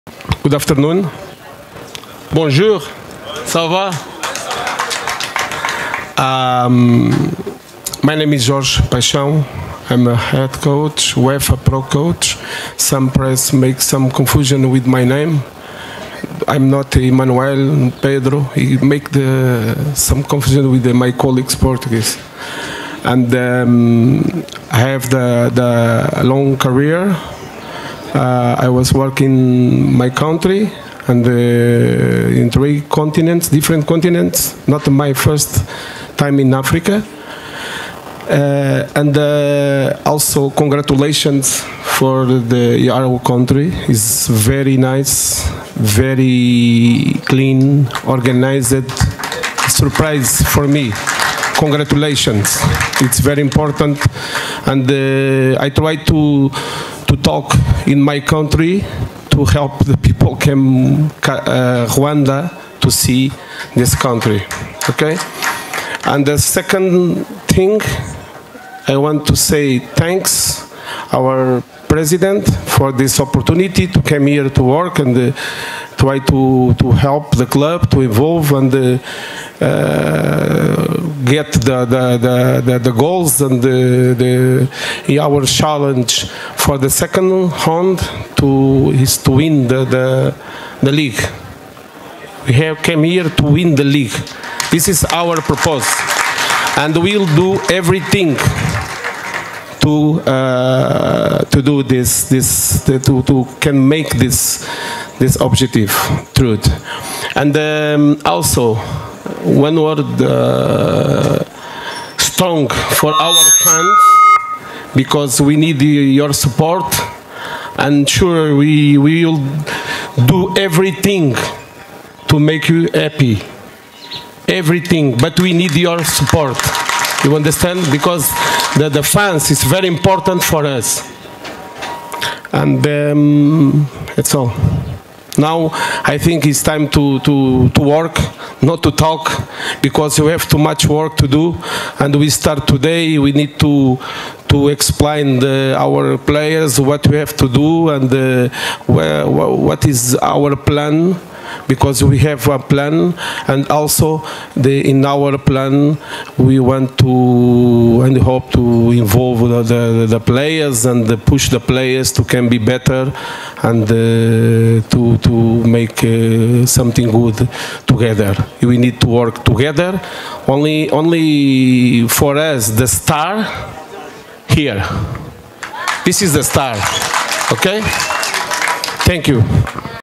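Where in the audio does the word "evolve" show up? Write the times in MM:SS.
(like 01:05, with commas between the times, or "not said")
01:18.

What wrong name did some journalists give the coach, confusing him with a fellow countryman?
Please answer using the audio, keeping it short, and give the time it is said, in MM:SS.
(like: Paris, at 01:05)
Emmanuel Pedro, at 00:16.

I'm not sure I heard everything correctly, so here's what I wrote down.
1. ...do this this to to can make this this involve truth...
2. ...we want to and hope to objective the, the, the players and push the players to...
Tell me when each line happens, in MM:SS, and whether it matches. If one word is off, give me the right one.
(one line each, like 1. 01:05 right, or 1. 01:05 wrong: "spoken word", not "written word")
1. 01:41 wrong: "objective", not "involve"
2. 02:36 wrong: "involve", not "objective".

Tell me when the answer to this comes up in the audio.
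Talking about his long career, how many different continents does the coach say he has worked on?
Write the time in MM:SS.
00:32.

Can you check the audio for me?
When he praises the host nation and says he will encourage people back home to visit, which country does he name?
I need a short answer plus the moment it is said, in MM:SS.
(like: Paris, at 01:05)
Rwanda, at 01:01.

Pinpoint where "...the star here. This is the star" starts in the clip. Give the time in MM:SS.
02:52.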